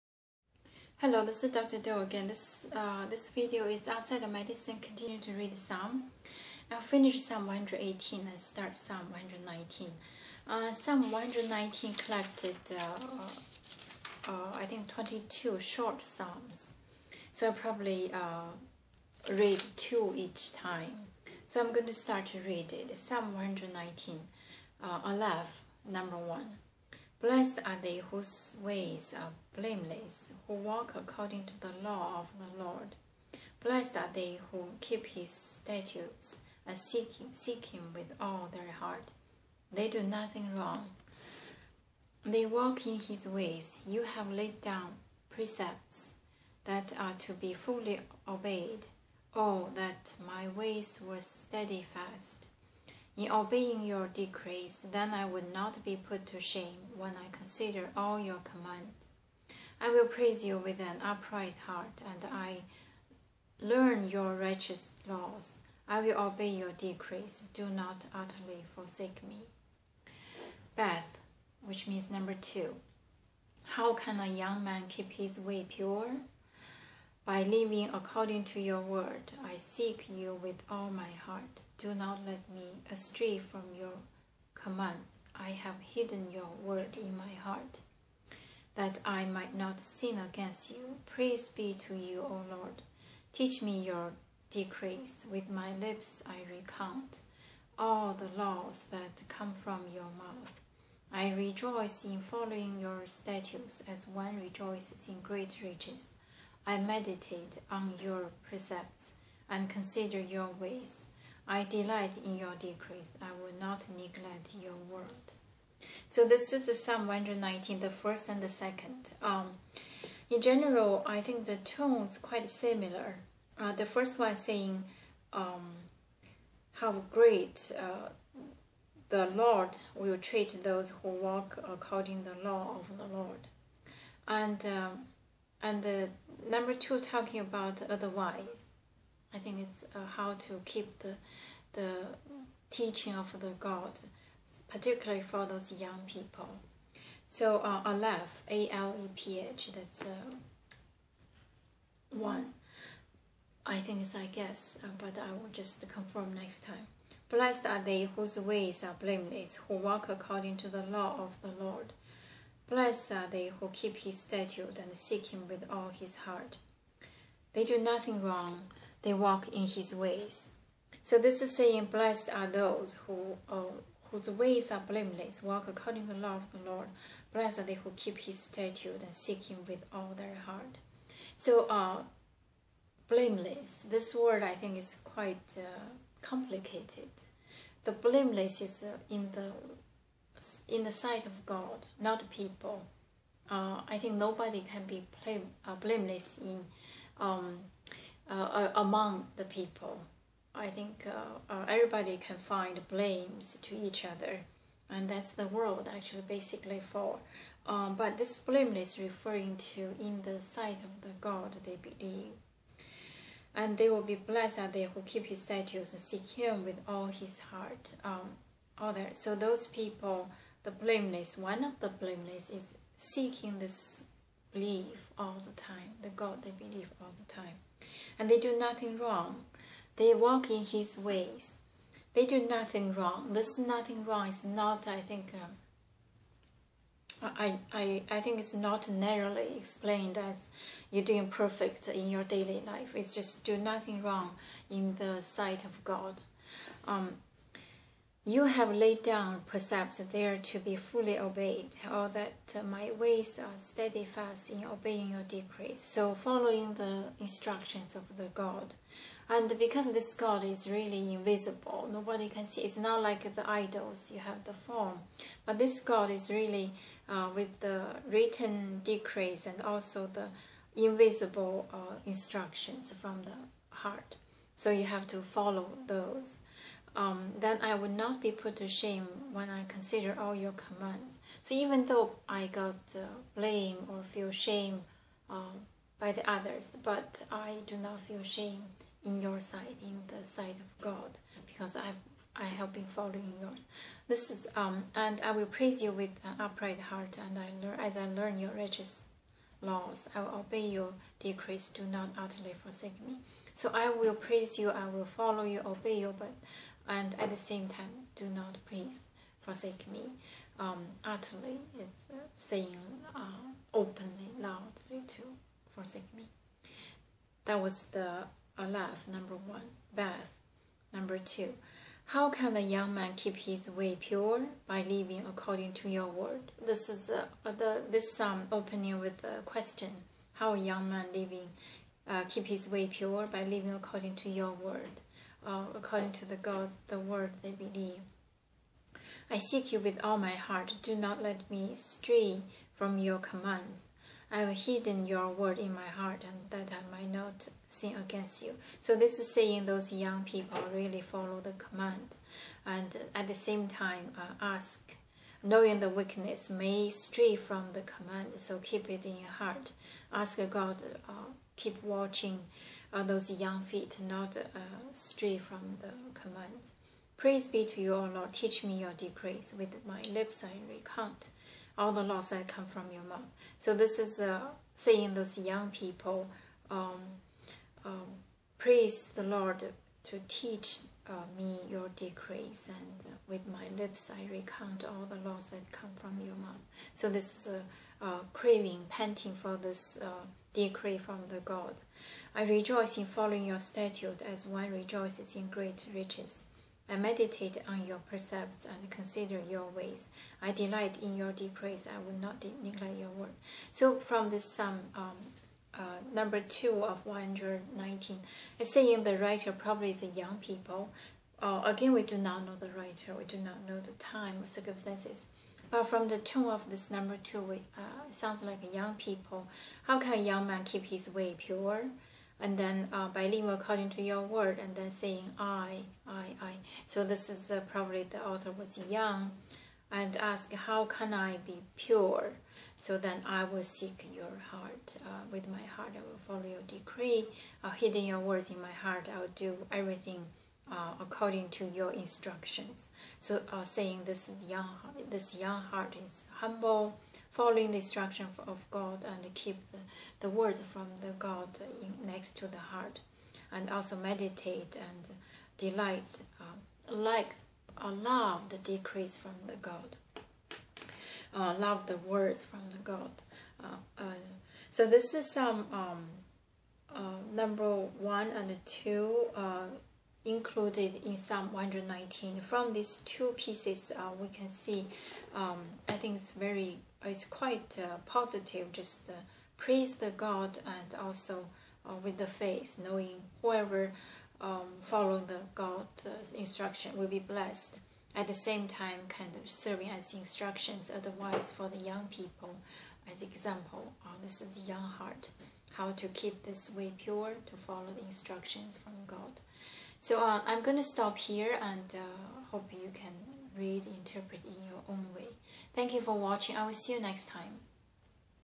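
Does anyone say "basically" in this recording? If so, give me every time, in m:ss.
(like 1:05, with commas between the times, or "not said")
3:26.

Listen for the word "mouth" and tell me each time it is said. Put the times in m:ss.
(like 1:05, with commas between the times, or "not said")
1:40, 6:13, 6:26.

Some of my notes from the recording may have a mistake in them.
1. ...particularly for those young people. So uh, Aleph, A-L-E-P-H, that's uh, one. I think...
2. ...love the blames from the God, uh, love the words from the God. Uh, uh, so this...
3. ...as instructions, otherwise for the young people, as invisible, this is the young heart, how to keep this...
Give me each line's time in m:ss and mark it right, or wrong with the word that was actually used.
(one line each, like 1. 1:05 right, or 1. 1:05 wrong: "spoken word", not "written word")
1. 2:24 right
2. 7:37 wrong: "decrees", not "blames"
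3. 8:09 wrong: "example", not "invisible".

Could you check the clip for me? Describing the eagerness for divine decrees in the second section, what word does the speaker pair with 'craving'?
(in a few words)
panting.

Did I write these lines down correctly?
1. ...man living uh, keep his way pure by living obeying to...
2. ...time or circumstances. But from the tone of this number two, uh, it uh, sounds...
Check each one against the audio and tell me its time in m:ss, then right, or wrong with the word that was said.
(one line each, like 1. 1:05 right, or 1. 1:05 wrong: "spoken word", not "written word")
1. 5:30 wrong: "according", not "obeying"
2. 6:53 right.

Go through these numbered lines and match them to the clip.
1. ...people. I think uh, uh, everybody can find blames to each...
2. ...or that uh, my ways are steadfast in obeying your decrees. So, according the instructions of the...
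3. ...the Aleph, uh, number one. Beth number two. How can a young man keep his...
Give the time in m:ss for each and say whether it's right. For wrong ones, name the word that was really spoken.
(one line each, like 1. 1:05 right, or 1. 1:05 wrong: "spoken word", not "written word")
1. 3:19 right
2. 4:11 wrong: "following", not "according"
3. 5:17 right.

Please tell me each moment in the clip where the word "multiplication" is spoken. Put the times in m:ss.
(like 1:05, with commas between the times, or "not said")
not said.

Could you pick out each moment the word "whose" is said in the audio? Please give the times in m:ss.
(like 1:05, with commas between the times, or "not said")
0:28, 2:38, 2:54.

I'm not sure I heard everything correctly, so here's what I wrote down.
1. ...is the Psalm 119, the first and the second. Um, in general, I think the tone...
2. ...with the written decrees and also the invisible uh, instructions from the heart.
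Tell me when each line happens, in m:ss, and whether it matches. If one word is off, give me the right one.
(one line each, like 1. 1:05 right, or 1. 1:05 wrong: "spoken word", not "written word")
1. 1:56 right
2. 4:27 right.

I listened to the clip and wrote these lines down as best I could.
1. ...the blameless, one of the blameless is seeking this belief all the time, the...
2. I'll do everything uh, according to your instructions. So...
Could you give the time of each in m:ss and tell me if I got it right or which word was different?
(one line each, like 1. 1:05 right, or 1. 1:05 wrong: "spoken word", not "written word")
1. 3:40 right
2. 7:19 right.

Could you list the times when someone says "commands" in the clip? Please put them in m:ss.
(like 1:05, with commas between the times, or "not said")
0:58, 1:24, 4:40, 5:43, 5:51, 5:57, 6:06.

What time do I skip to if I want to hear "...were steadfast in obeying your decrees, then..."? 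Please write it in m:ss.
0:51.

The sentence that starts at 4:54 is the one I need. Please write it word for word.
This is um, and I will praise you with an upright heart, and I learn as I learn your righteous laws.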